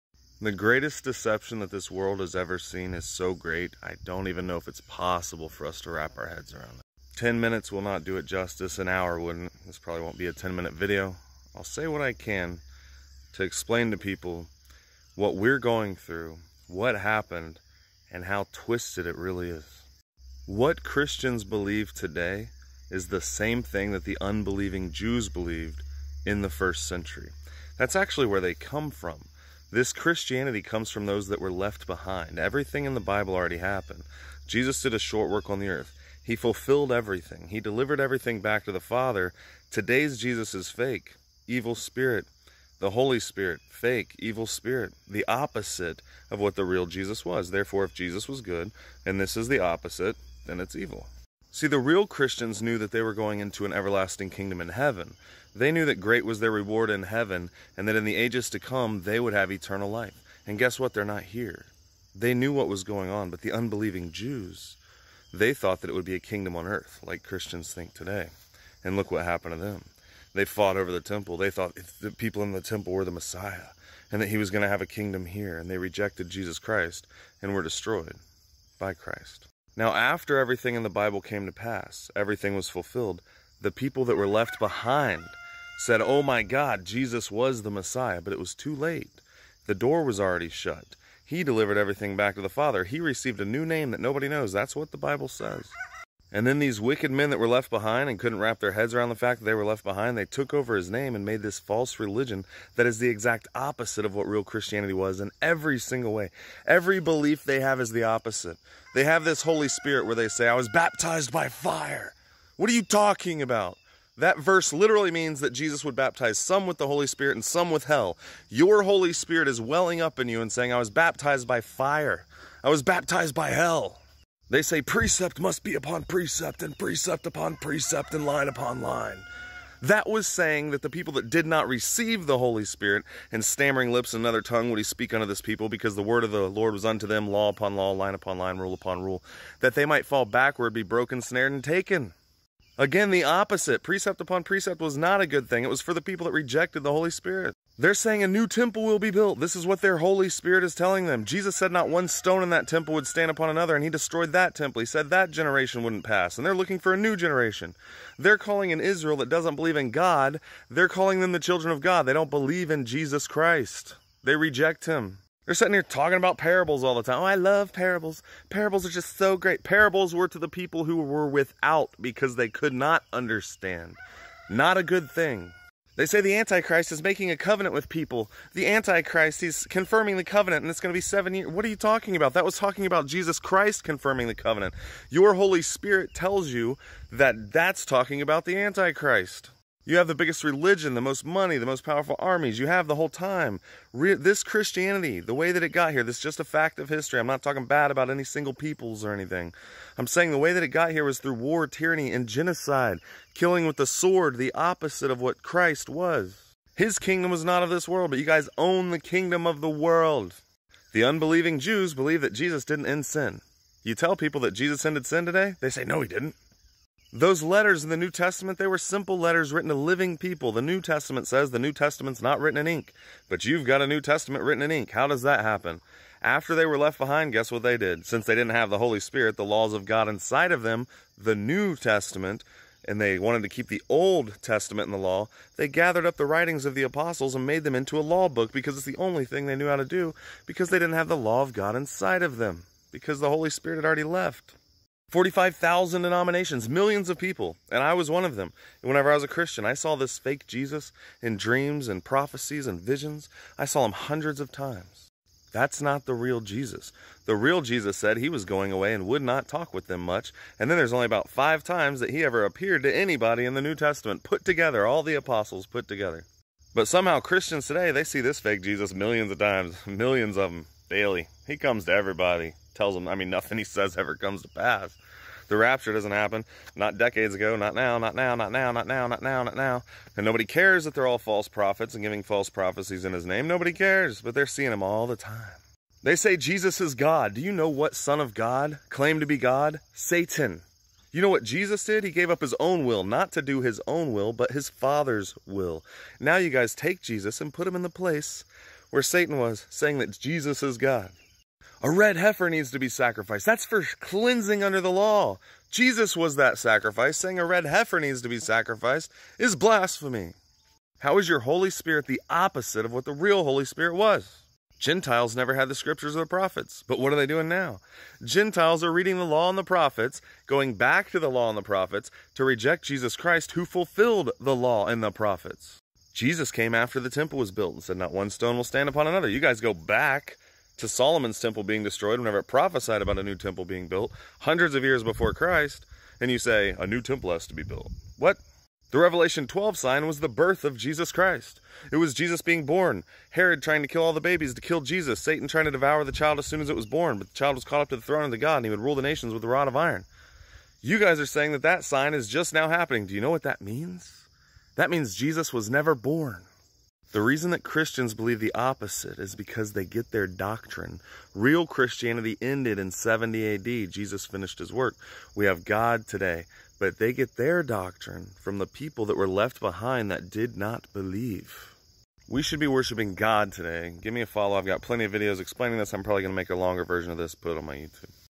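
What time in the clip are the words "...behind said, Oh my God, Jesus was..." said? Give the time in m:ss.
1:24.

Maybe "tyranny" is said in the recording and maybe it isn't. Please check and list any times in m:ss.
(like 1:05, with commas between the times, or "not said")
3:21.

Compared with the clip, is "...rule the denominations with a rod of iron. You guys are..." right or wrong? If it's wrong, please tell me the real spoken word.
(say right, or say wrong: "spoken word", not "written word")
wrong: "nations", not "denominations".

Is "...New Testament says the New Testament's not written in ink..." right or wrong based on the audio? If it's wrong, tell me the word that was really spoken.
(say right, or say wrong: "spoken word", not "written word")
right.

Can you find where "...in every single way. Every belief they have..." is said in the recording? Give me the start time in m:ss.
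1:45.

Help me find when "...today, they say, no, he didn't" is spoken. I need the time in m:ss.
3:35.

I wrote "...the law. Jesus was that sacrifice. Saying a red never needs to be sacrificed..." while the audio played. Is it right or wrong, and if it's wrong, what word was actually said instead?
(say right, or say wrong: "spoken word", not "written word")
wrong: "heifer", not "never".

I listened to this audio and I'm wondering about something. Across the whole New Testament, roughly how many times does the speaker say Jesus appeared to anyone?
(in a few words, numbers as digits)
5.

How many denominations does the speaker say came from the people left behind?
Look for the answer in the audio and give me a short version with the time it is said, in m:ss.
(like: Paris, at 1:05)
45,000, at 4:05.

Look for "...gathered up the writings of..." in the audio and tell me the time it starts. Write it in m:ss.
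3:55.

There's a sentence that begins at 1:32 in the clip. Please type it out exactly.
He received a new name that nobody knows.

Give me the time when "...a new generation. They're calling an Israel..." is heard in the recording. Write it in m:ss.
2:36.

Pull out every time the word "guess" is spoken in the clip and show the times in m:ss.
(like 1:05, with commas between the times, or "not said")
1:00, 3:47.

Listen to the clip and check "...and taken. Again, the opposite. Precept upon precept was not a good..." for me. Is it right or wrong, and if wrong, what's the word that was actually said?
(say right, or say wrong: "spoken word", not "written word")
right.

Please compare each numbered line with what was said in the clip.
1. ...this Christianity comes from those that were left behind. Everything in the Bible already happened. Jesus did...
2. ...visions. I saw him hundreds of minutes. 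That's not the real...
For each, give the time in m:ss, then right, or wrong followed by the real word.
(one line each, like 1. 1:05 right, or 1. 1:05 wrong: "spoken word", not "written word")
1. 0:29 right
2. 4:12 wrong: "times", not "minutes".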